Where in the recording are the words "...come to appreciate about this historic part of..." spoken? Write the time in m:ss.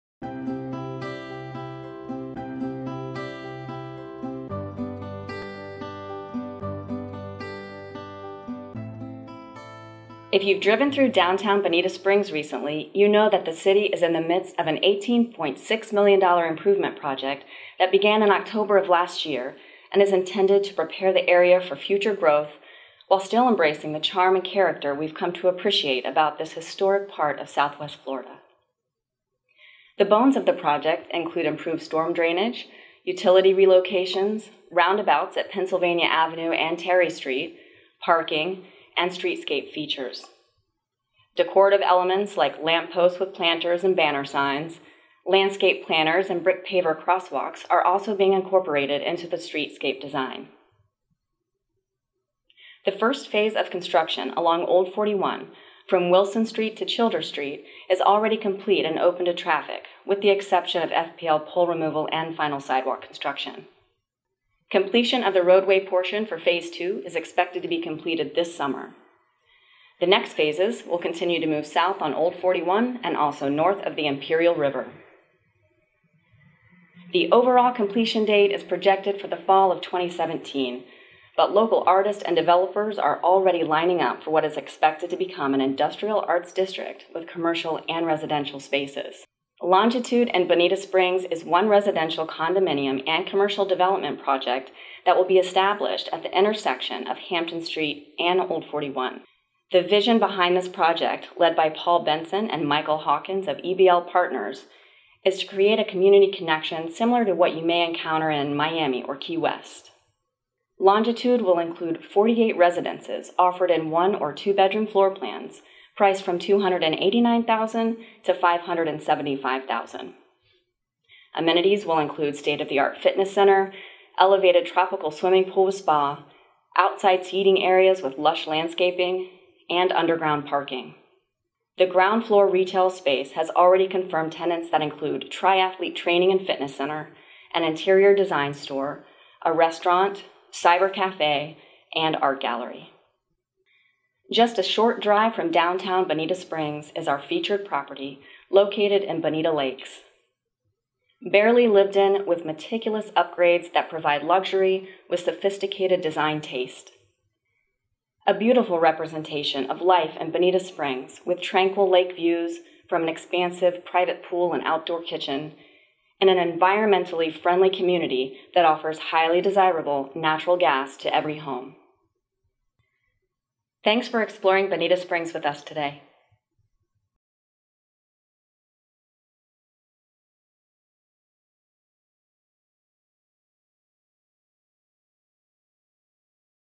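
0:25.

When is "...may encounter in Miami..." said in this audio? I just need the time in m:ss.
1:47.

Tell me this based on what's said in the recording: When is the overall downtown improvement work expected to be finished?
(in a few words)
fall of 2017.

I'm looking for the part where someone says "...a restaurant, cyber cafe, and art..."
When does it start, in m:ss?
2:19.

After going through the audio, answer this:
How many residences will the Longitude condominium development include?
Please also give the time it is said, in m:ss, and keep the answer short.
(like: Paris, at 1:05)
48, at 1:52.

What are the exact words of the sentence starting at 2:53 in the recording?
Thanks for exploring Bonita Springs with us today.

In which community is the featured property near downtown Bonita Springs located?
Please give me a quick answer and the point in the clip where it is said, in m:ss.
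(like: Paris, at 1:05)
Bonita Lakes, at 2:29.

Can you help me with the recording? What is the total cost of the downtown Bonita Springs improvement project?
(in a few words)
$18.6 million.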